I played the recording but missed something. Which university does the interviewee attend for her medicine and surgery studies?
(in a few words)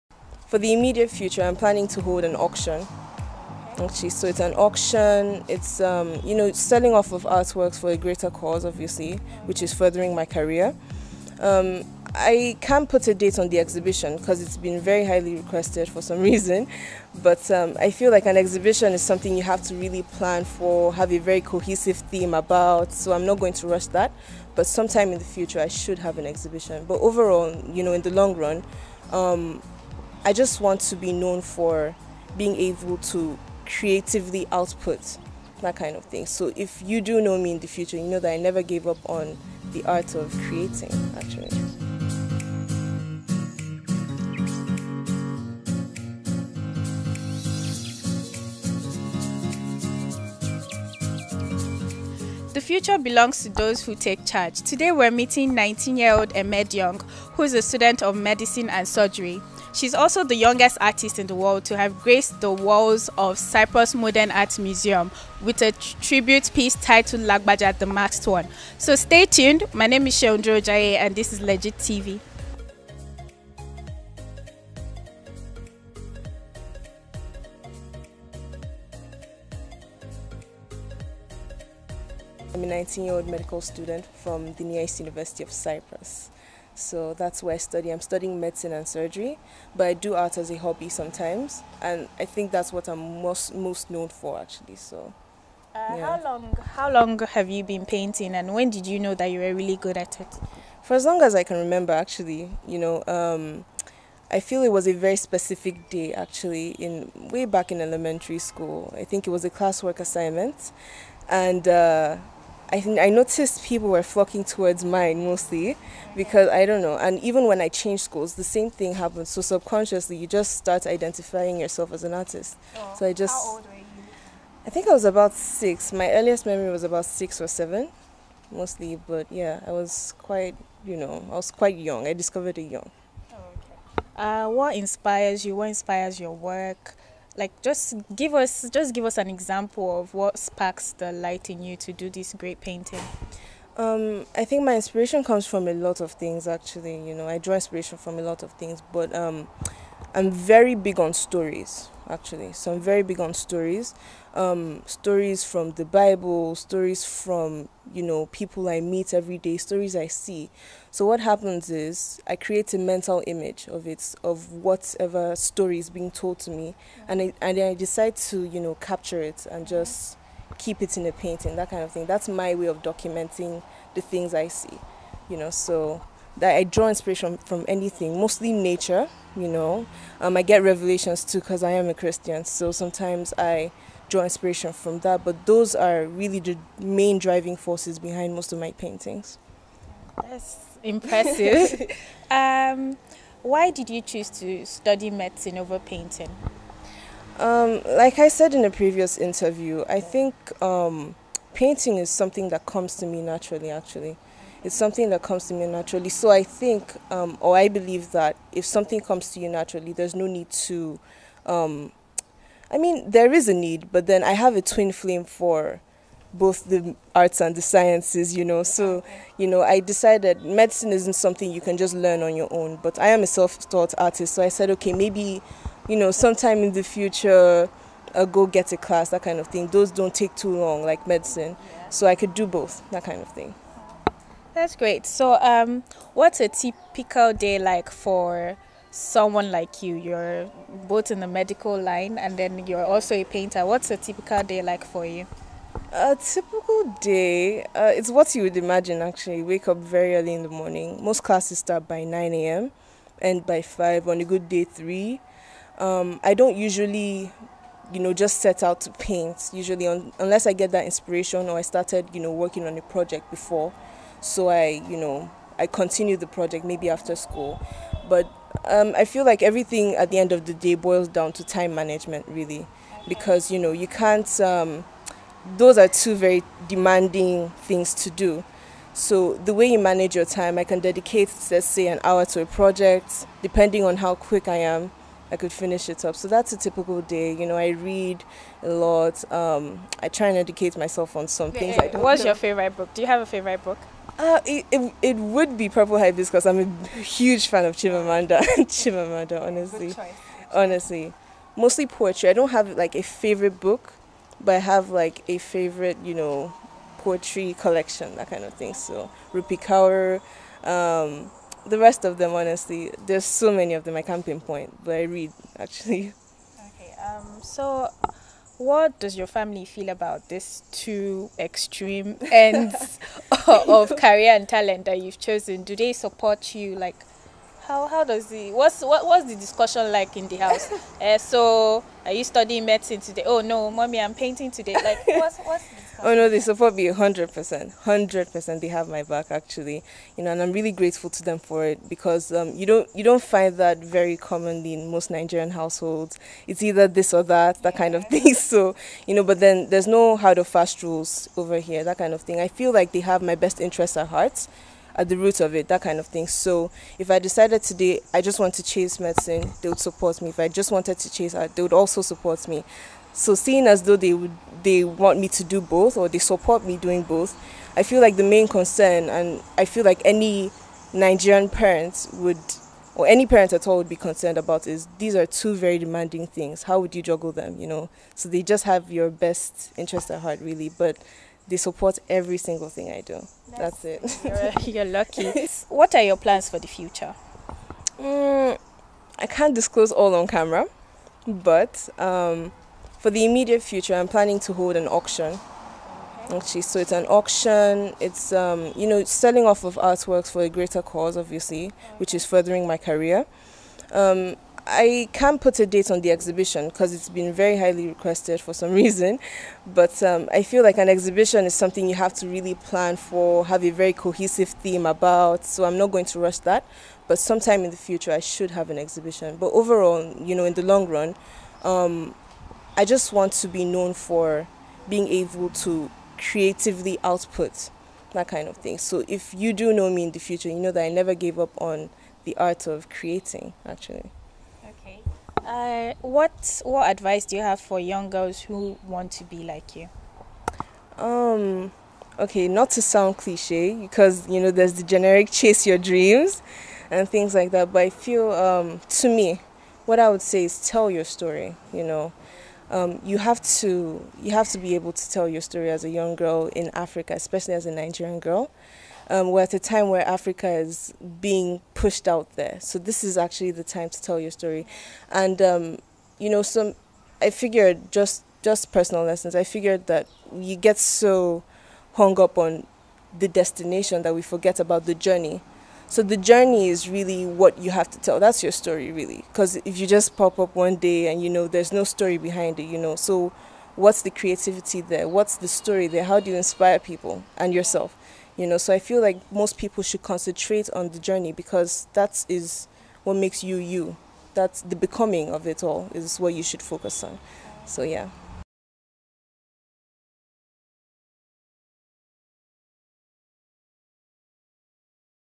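Near East University.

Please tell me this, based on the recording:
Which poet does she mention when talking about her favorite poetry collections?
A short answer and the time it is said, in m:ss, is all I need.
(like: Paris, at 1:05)
Rupi Kaur, at 5:09.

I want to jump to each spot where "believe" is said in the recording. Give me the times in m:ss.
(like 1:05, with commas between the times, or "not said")
3:27.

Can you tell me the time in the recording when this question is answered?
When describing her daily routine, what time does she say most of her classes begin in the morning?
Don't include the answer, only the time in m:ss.
4:12.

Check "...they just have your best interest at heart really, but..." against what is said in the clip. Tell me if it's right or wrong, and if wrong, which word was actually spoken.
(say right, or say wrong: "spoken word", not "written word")
right.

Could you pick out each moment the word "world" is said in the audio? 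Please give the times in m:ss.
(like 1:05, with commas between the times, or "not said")
1:01.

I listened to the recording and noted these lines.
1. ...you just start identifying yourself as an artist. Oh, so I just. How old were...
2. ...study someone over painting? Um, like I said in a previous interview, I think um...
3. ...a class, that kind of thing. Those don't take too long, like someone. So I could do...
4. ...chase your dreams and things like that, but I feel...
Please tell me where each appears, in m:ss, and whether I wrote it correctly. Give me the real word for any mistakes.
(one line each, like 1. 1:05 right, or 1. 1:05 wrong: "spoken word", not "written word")
1. 2:00 right
2. 3:14 wrong: "medicine", not "someone"
3. 3:48 wrong: "medicine", not "someone"
4. 7:25 right.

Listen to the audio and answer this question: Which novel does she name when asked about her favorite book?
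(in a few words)
Purple Hibiscus.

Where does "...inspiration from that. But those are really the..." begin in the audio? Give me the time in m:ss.
3:04.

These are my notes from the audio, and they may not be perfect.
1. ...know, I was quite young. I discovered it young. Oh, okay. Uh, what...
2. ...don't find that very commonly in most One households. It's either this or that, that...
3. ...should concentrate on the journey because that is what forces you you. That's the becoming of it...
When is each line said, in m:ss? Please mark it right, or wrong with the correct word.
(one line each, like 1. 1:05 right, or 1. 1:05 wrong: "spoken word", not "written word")
1. 2:10 right
2. 5:43 wrong: "Nigerian", not "One"
3. 8:09 wrong: "makes", not "forces".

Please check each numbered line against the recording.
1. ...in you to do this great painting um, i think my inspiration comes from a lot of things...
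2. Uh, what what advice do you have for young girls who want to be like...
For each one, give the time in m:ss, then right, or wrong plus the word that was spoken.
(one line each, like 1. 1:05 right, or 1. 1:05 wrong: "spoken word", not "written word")
1. 2:21 right
2. 7:15 right.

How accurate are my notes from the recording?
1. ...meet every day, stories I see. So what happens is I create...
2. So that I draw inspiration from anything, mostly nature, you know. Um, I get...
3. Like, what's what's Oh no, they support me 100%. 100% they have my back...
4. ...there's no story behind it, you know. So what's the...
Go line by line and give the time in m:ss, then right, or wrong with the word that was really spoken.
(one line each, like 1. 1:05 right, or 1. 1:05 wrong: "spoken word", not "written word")
1. 2:38 right
2. 2:55 right
3. 5:34 right
4. 8:01 right.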